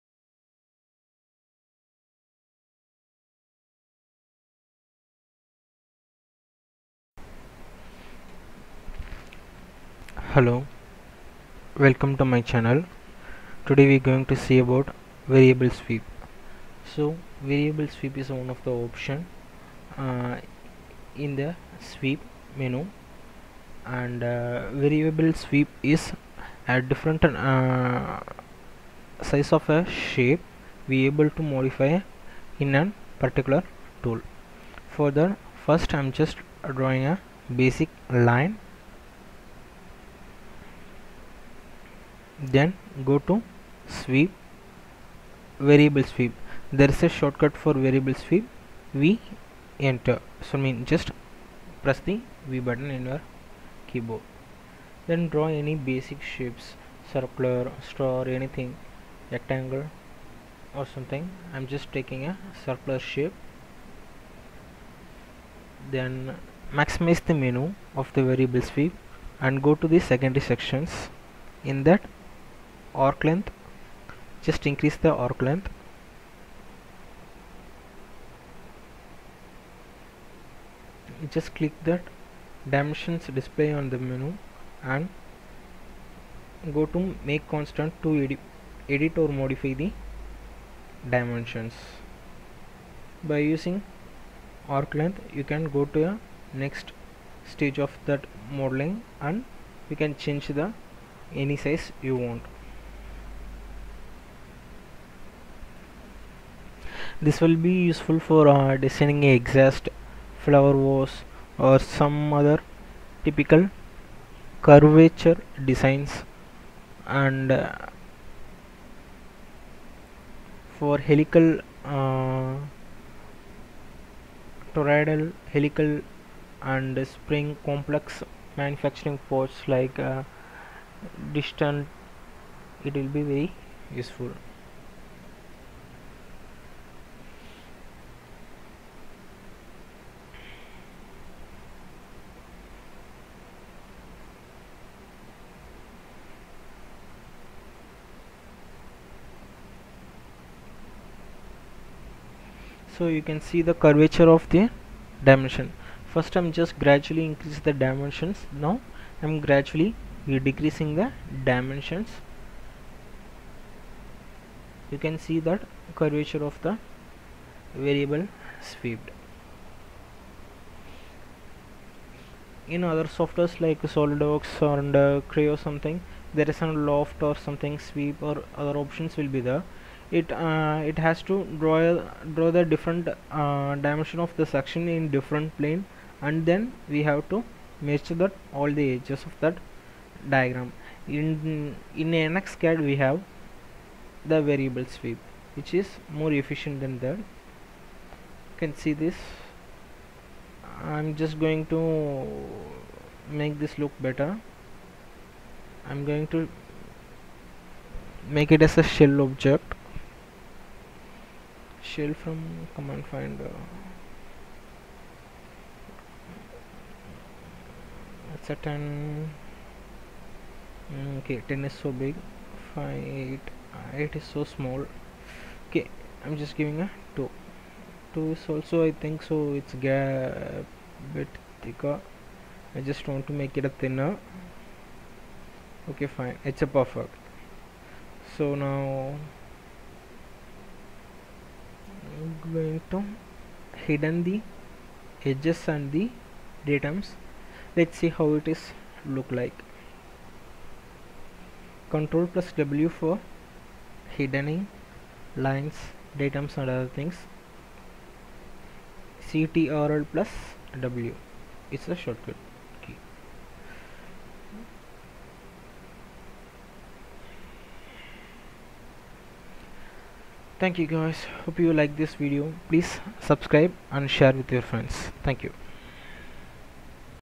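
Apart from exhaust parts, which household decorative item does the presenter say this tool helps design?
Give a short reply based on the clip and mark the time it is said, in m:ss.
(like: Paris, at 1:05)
flower vase, at 1:50.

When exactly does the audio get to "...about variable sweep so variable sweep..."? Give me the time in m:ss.
0:14.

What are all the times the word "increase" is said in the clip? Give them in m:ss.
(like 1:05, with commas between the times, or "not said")
1:14, 2:37.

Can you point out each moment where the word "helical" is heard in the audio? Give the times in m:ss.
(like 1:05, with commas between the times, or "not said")
2:01, 2:05.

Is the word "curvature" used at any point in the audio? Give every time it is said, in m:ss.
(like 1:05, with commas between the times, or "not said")
1:54, 2:33, 2:45.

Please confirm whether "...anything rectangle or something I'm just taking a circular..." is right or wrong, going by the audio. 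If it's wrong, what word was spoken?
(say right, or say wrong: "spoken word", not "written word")
right.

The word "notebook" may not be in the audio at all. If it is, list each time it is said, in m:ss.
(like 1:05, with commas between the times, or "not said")
not said.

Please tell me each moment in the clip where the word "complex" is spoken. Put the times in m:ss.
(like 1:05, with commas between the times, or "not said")
2:07.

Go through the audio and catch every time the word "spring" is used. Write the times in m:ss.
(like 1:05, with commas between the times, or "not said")
2:07.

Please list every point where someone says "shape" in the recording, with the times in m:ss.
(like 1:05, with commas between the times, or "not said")
0:29, 0:56, 1:02.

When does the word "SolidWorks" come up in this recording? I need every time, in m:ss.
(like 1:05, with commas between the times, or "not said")
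2:53.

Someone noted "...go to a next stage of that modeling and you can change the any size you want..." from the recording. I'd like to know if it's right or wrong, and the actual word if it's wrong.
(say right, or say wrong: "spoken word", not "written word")
right.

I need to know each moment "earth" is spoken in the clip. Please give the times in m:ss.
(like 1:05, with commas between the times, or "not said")
not said.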